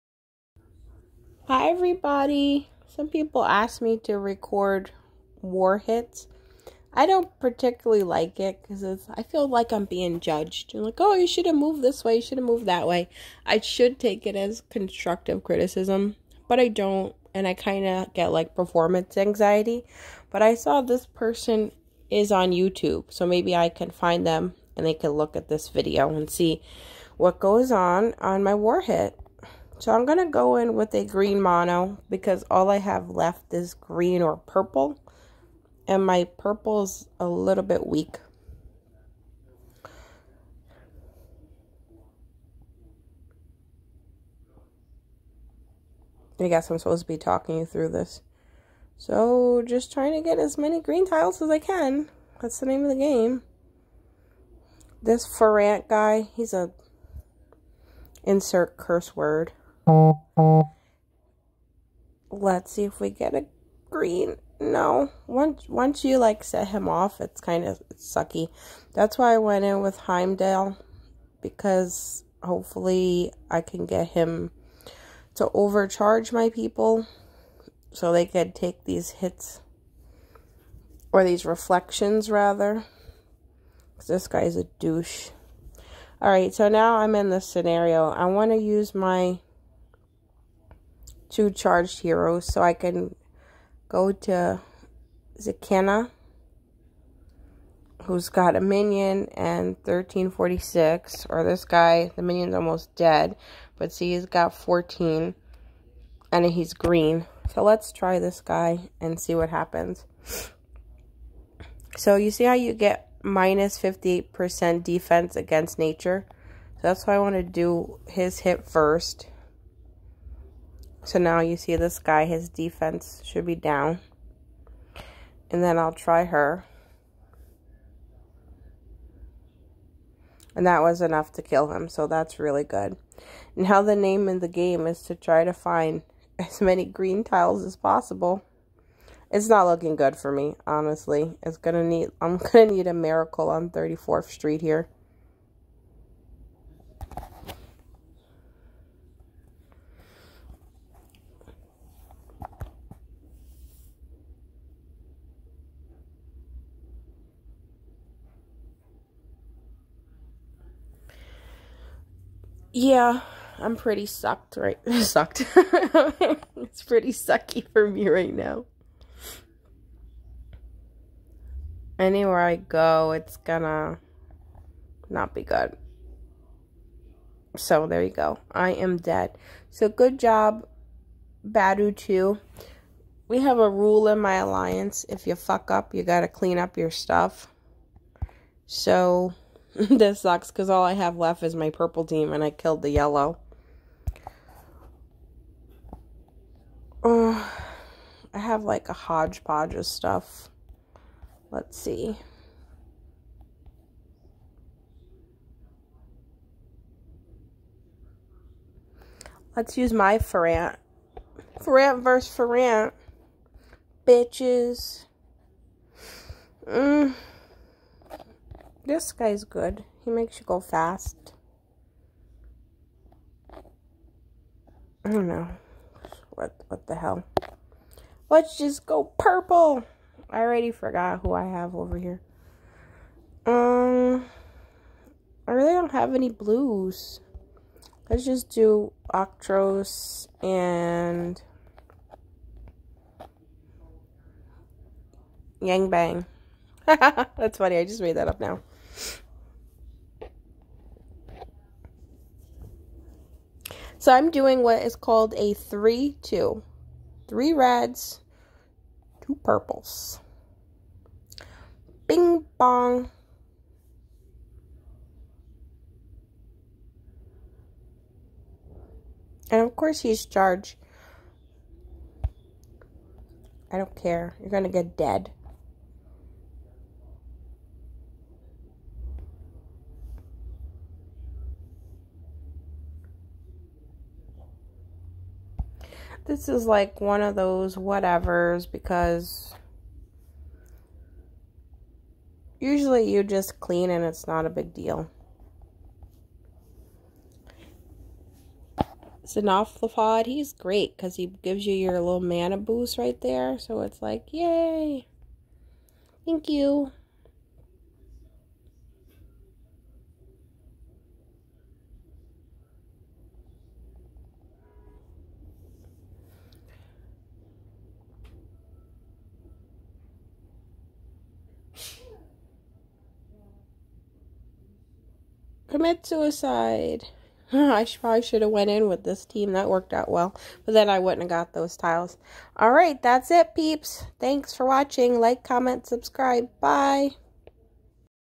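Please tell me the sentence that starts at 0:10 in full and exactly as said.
like, oh, you should have moved this way, you should have moved that way.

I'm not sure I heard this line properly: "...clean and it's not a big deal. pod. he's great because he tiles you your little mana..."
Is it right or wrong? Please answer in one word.
wrong.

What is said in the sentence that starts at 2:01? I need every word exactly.
So now you see this guy, his defense should be down.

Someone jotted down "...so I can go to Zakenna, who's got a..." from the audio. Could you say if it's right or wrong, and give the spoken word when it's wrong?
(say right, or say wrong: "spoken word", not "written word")
right.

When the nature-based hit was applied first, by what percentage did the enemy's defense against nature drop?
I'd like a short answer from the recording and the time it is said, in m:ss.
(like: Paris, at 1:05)
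58%, at 1:53.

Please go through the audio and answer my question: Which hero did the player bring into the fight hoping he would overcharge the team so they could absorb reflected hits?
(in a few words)
Heimdall.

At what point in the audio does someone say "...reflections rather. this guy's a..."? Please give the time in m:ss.
1:21.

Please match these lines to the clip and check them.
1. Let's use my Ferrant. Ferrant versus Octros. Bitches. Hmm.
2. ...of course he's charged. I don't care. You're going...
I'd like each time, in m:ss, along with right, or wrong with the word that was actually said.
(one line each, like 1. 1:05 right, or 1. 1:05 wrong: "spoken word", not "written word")
1. 3:29 wrong: "Ferrant", not "Octros"
2. 4:29 right.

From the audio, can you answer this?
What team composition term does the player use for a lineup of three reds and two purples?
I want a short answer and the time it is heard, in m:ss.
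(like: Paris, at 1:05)
3-2, at 4:15.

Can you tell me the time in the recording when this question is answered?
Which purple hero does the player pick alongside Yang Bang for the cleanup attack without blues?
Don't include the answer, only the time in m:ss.
3:59.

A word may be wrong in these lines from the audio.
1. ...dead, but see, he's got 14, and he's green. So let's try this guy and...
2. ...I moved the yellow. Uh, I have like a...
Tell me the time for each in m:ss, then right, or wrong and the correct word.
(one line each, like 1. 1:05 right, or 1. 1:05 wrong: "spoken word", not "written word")
1. 1:42 right
2. 3:12 wrong: "killed", not "moved".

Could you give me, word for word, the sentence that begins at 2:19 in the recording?
It's not looking good for me, honestly.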